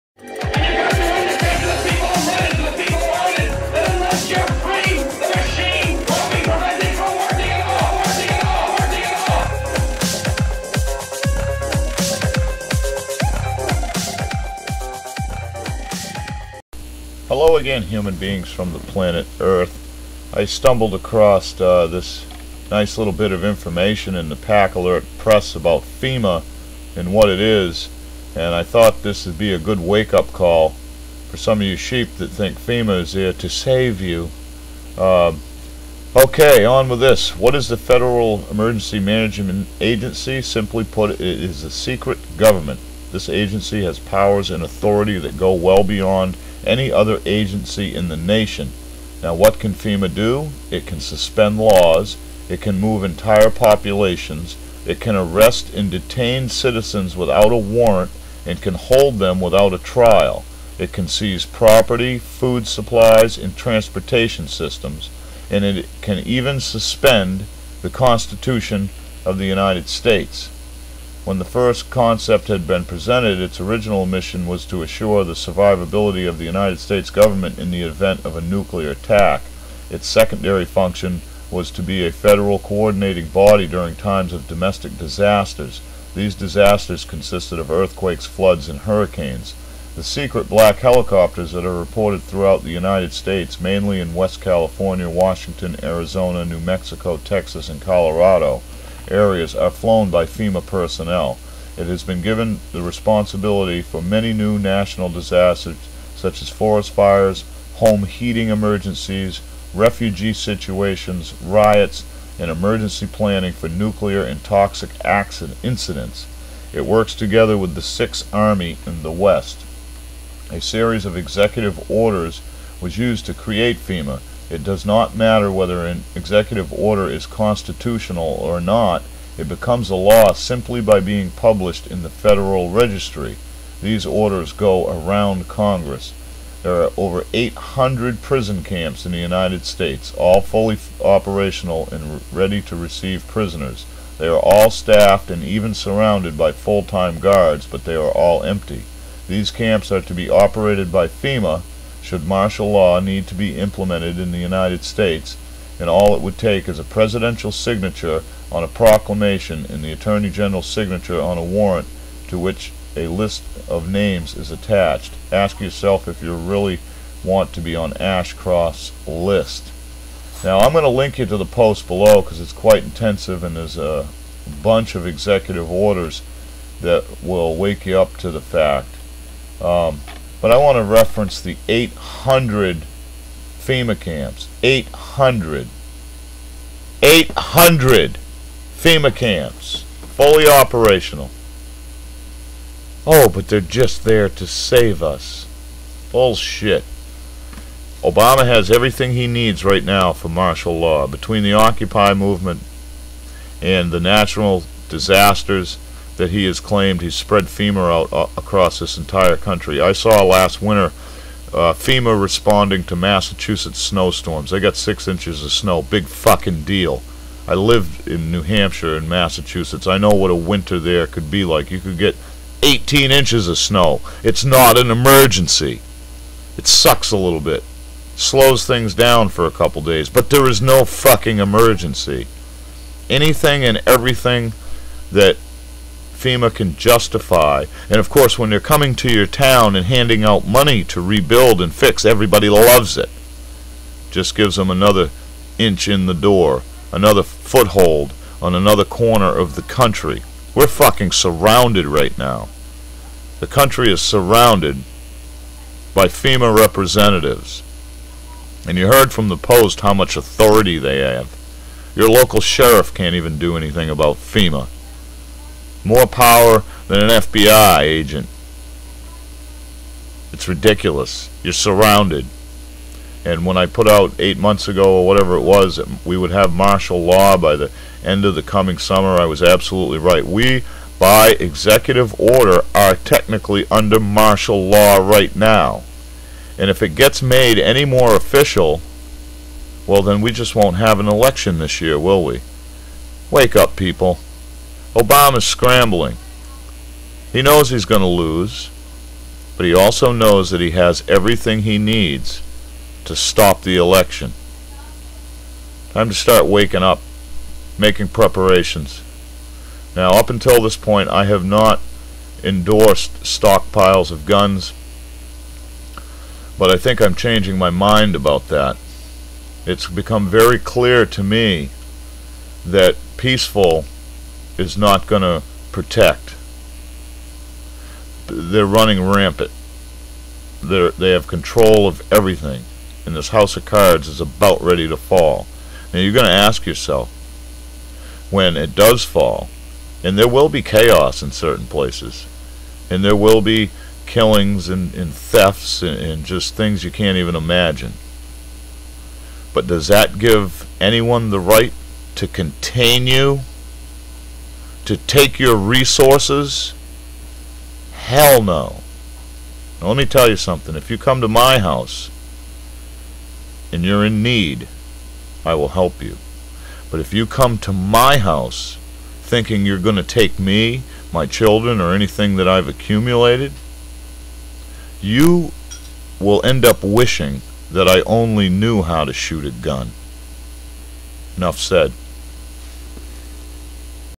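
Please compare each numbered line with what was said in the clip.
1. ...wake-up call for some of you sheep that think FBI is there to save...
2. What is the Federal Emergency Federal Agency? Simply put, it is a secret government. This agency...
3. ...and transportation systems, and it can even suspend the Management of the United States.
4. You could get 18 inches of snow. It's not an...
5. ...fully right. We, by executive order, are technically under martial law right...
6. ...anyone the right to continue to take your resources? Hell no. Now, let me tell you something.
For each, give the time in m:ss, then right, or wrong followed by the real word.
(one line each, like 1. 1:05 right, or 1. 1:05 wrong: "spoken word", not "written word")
1. 0:29 wrong: "FEMA", not "FBI"
2. 0:37 wrong: "Management", not "Federal"
3. 1:03 wrong: "Constitution", not "Management"
4. 3:41 right
5. 4:39 wrong: "absolutely", not "fully"
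6. 5:50 right.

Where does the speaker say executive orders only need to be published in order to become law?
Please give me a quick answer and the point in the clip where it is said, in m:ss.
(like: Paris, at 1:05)
Federal Registry, at 2:12.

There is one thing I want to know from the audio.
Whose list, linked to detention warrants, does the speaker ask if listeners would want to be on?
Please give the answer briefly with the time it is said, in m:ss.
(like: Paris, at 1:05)
Ashcroft, at 2:47.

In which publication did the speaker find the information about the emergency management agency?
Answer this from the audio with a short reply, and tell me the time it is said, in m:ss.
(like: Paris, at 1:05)
Pak Alert Press, at 0:24.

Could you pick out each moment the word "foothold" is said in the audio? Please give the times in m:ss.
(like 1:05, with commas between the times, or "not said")
4:07.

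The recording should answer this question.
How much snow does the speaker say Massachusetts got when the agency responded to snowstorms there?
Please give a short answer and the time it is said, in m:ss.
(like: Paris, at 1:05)
6 inches, at 3:34.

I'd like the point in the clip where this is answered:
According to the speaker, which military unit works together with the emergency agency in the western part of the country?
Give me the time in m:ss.
1:57.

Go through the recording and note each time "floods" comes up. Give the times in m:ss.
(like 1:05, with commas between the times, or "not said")
1:28.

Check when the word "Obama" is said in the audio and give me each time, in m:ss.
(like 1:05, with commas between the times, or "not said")
3:18, 4:54.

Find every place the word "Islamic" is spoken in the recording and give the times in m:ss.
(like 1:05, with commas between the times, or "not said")
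not said.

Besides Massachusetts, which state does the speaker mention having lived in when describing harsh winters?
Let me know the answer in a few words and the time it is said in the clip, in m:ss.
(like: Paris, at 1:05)
New Hampshire, at 3:38.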